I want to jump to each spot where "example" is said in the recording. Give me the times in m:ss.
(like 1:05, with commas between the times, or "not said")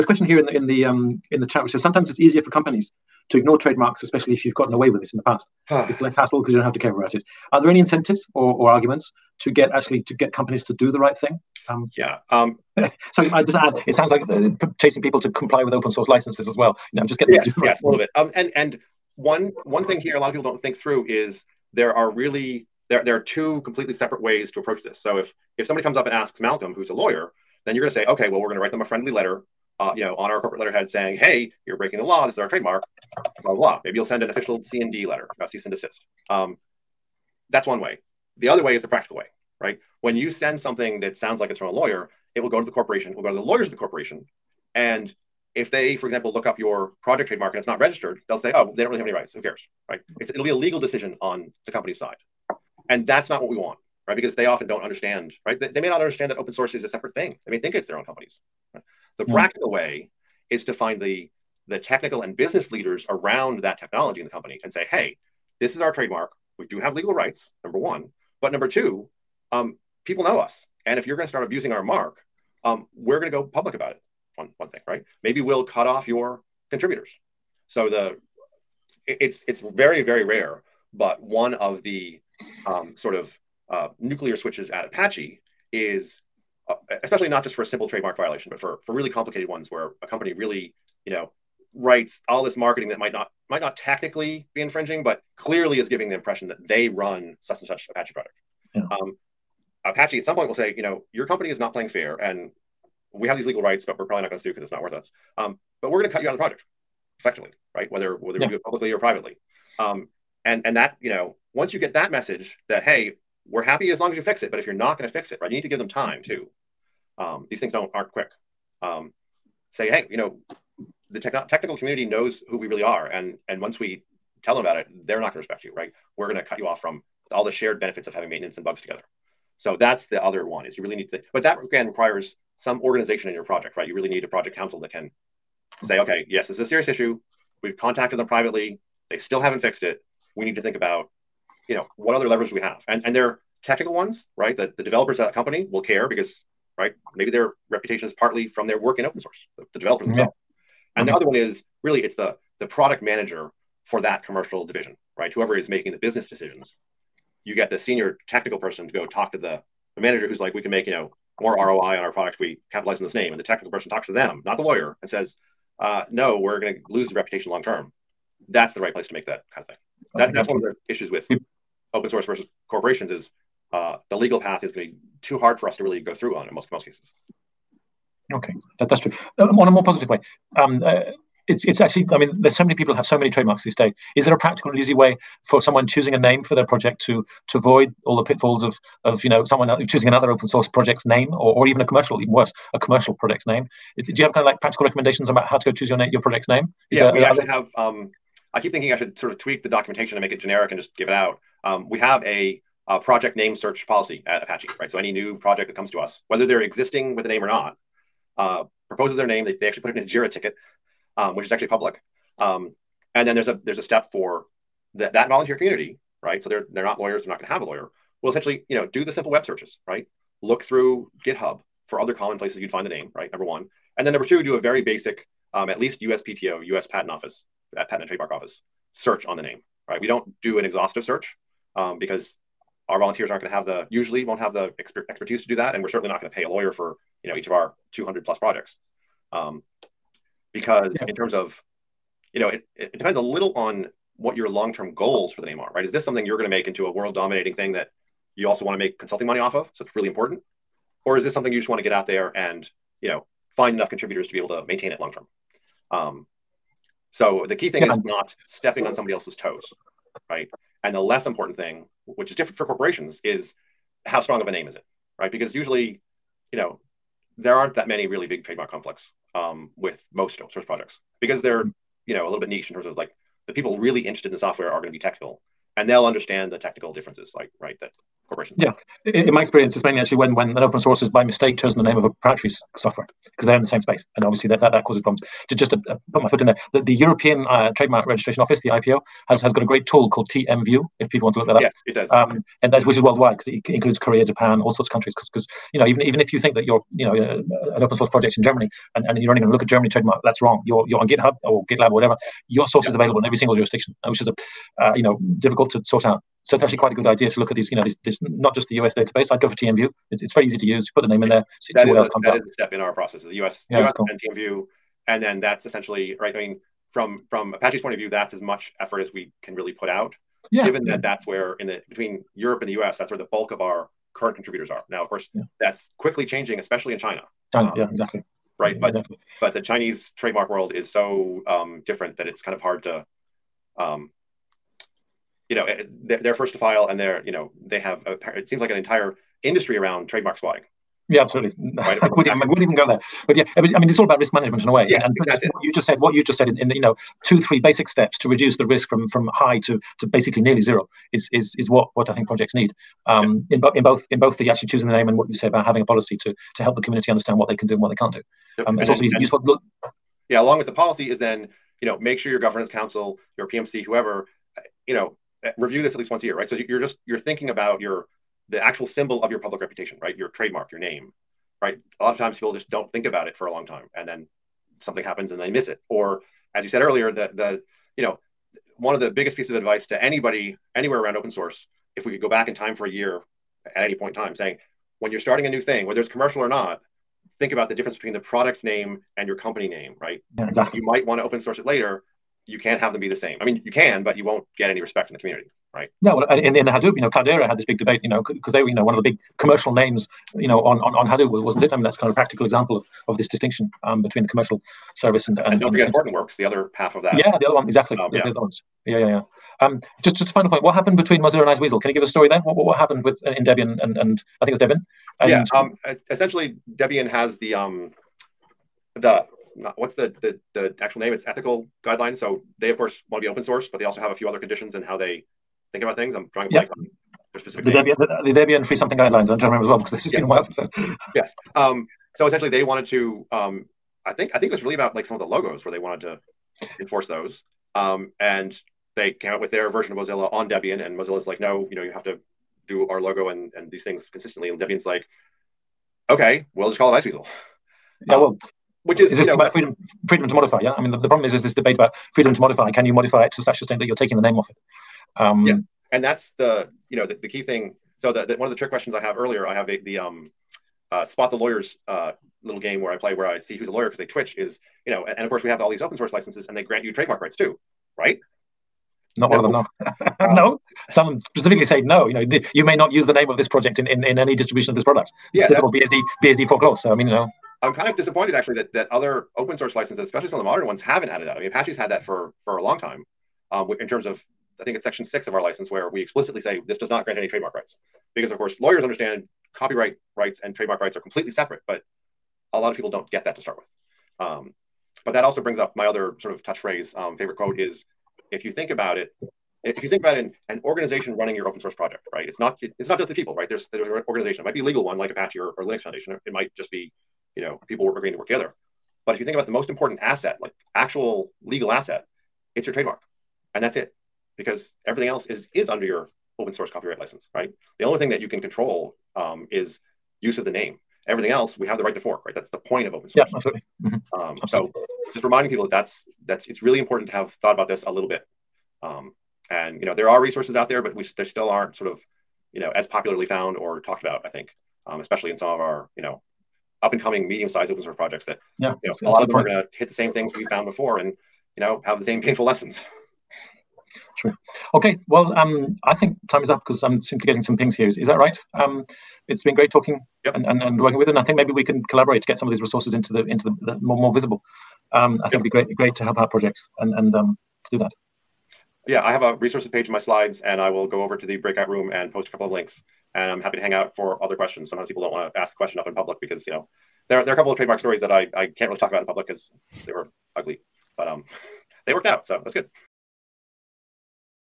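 0:46, 6:42.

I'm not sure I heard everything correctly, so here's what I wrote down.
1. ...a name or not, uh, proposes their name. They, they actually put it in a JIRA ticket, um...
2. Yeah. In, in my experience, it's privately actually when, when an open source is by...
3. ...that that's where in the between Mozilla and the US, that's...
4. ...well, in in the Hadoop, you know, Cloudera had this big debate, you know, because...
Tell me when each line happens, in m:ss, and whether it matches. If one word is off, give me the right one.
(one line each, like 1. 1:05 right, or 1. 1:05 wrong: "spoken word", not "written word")
1. 3:27 right
2. 4:38 wrong: "mainly", not "privately"
3. 5:20 wrong: "Europe", not "Mozilla"
4. 6:36 right.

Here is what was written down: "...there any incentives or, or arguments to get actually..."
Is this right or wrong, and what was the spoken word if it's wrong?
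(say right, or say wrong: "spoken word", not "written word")
right.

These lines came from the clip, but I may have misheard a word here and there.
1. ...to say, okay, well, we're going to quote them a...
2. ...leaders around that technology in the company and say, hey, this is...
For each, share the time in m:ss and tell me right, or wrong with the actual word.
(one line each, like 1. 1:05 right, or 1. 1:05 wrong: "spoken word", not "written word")
1. 0:27 wrong: "write", not "quote"
2. 1:02 right.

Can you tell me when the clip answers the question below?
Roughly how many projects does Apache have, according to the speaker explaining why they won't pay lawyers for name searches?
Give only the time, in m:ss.
3:57.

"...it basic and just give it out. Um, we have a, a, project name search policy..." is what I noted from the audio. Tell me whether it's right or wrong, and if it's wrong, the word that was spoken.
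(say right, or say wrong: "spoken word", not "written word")
wrong: "generic", not "basic".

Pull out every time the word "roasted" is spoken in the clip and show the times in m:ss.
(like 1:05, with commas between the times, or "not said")
not said.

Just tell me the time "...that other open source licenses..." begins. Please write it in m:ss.
7:58.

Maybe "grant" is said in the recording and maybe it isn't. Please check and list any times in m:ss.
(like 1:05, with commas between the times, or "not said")
7:46, 8:07.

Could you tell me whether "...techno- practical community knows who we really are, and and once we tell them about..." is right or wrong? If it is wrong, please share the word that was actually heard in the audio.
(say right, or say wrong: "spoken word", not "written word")
wrong: "technical", not "practical".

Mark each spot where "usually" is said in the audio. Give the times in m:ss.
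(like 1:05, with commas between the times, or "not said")
3:53, 4:25.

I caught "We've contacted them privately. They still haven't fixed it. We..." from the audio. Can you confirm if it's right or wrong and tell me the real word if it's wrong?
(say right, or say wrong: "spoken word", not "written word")
right.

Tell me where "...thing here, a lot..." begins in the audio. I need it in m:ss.
0:19.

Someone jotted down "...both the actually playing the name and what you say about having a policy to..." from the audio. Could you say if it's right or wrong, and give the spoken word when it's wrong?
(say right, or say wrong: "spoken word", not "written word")
wrong: "choosing", not "playing".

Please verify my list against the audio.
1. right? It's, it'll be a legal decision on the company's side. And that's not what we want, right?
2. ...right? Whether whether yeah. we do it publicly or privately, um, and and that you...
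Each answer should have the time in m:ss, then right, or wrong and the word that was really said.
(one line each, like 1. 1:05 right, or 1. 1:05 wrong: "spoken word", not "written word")
1. 0:49 right
2. 1:47 right.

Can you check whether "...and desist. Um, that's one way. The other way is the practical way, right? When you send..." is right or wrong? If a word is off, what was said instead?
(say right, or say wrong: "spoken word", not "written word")
right.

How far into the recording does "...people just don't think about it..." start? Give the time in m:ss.
6:12.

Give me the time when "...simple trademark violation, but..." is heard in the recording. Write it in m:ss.
1:27.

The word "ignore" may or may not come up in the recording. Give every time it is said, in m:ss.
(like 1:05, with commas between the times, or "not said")
0:03.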